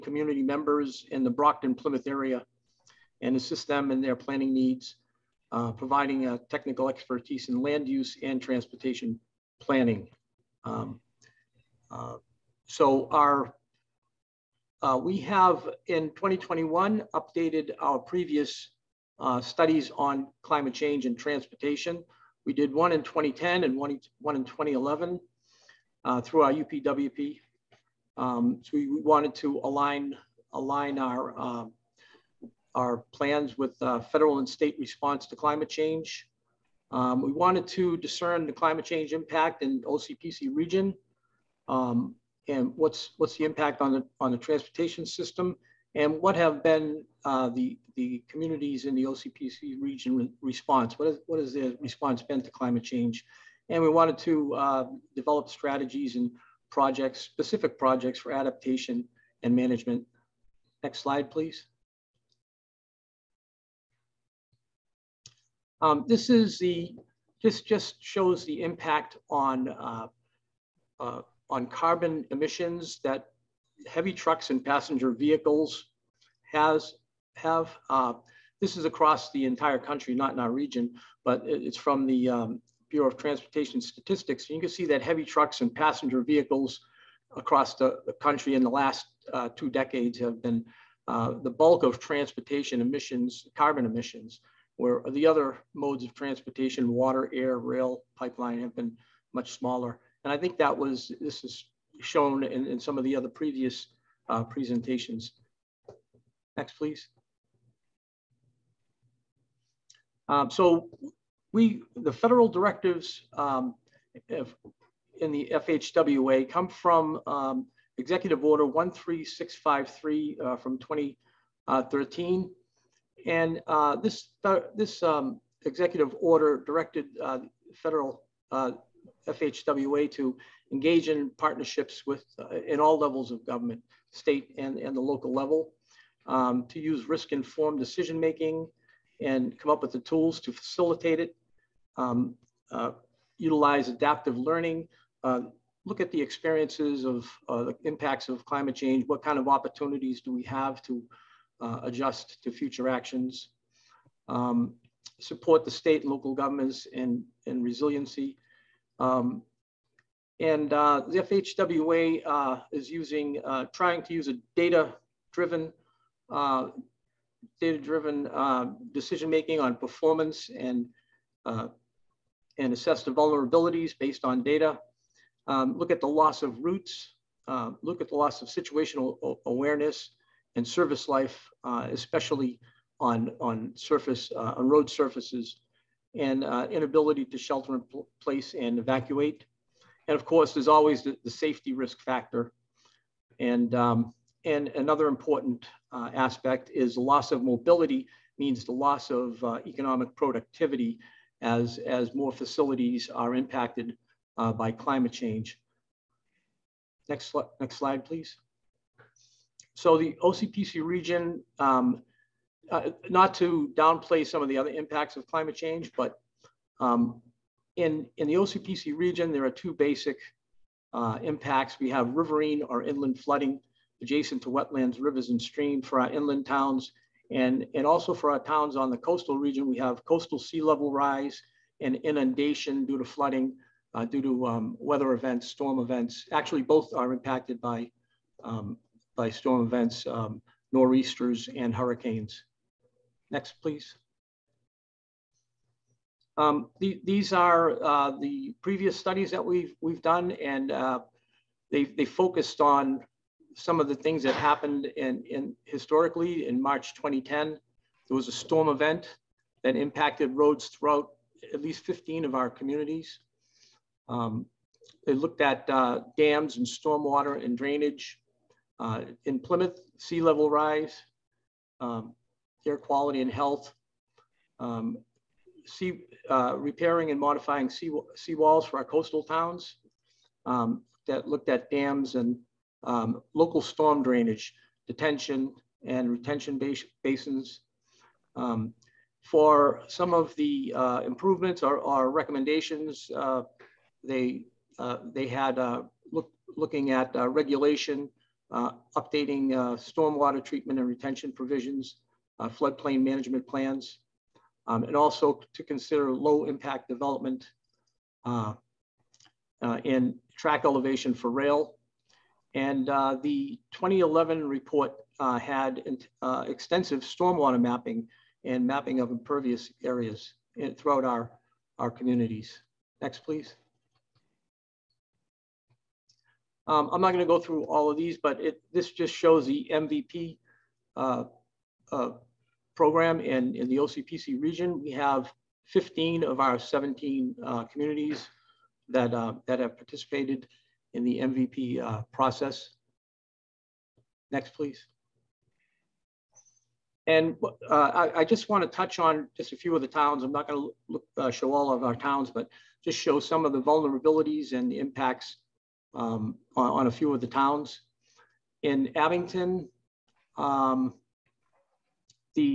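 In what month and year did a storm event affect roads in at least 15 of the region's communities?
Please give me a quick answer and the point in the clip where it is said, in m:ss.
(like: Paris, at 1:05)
March 2010, at 4:16.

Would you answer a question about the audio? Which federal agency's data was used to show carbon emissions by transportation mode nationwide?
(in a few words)
Bureau of Transportation Statistics.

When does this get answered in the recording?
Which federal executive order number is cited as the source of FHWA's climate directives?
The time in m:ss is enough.
1:57.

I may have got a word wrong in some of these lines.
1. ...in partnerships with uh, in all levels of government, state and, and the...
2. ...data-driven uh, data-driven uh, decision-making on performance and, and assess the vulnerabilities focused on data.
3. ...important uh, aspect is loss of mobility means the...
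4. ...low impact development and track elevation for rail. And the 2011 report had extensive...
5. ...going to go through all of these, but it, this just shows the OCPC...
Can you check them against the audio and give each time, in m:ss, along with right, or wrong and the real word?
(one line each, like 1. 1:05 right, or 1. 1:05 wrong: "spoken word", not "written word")
1. 2:11 right
2. 2:44 wrong: "based", not "focused"
3. 3:15 right
4. 5:06 right
5. 5:27 wrong: "MVP", not "OCPC".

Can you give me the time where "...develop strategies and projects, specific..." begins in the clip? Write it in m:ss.
0:55.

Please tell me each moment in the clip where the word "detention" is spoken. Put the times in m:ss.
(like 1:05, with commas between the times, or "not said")
4:44.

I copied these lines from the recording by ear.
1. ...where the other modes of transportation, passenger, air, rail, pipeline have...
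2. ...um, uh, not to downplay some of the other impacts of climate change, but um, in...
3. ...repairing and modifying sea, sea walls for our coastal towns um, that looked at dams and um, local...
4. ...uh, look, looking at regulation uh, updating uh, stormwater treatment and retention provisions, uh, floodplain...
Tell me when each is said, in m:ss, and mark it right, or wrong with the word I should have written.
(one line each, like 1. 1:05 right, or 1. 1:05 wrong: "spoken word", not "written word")
1. 1:34 wrong: "water", not "passenger"
2. 3:31 right
3. 4:36 right
4. 4:55 right.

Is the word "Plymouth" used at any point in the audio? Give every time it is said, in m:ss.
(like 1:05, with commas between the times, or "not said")
0:01, 4:29.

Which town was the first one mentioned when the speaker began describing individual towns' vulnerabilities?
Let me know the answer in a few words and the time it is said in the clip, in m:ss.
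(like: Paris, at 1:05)
Abington, at 5:58.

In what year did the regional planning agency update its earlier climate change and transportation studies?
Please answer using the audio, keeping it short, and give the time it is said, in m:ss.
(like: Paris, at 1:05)
2021, at 0:16.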